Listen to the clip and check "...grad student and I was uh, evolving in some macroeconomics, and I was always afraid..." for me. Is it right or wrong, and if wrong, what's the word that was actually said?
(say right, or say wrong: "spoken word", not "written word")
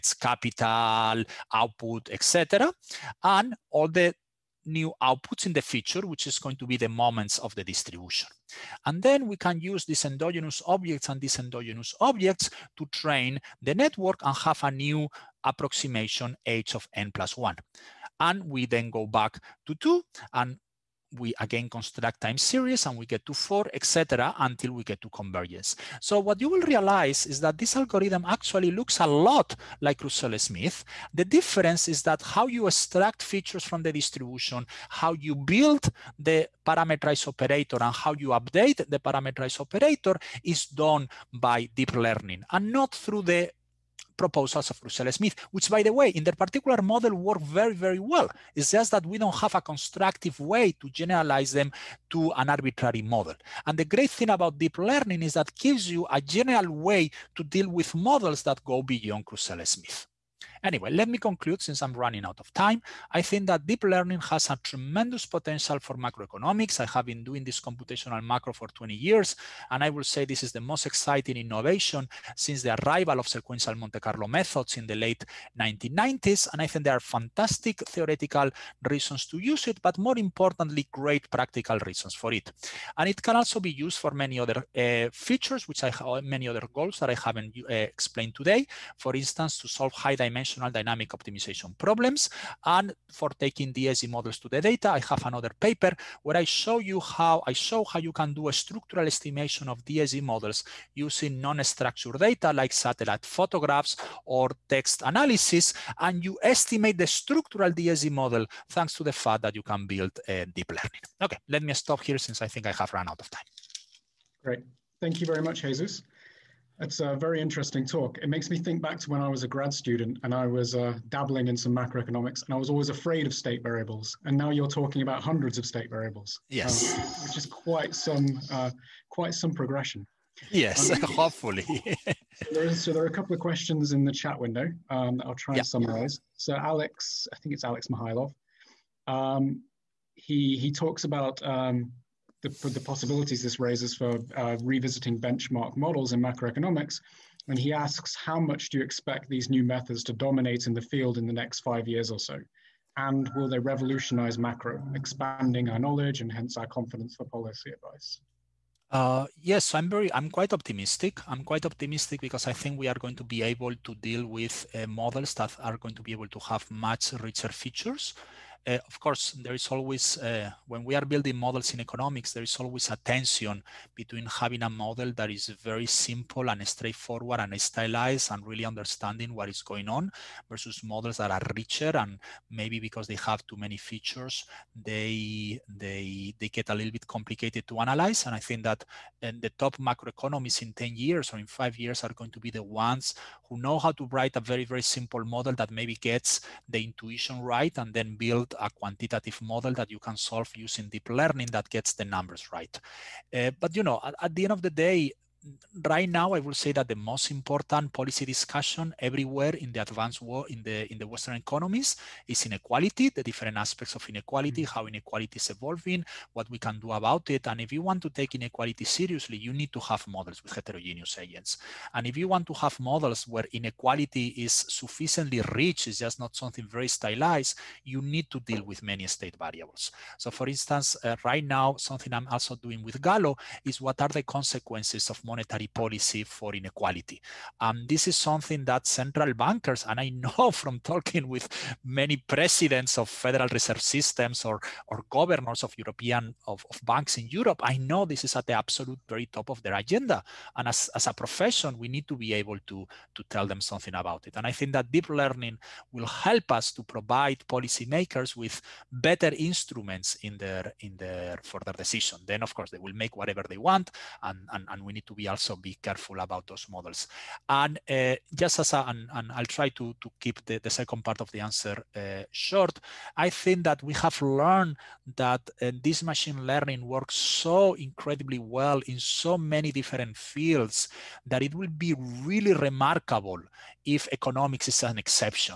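wrong: "dabbling", not "evolving".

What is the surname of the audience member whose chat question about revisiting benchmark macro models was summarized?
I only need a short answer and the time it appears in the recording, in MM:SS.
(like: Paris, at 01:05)
Mihailov, at 02:17.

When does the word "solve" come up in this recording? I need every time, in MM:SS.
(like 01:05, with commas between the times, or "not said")
01:29, 03:20.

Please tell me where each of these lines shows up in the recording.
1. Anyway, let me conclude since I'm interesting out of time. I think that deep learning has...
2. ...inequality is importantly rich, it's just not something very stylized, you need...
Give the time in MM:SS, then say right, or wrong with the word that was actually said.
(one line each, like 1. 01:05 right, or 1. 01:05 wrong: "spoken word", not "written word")
1. 01:00 wrong: "running", not "interesting"
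2. 03:43 wrong: "sufficiently", not "importantly".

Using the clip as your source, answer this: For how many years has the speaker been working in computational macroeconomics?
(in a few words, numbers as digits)
20.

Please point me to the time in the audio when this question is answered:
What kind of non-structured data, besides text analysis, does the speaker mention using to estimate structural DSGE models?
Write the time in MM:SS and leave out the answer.
01:42.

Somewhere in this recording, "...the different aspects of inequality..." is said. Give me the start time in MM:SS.
03:33.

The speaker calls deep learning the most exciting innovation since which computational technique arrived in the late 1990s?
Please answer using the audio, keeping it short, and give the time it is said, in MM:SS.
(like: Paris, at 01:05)
Sequential Monte Carlo methods, at 01:13.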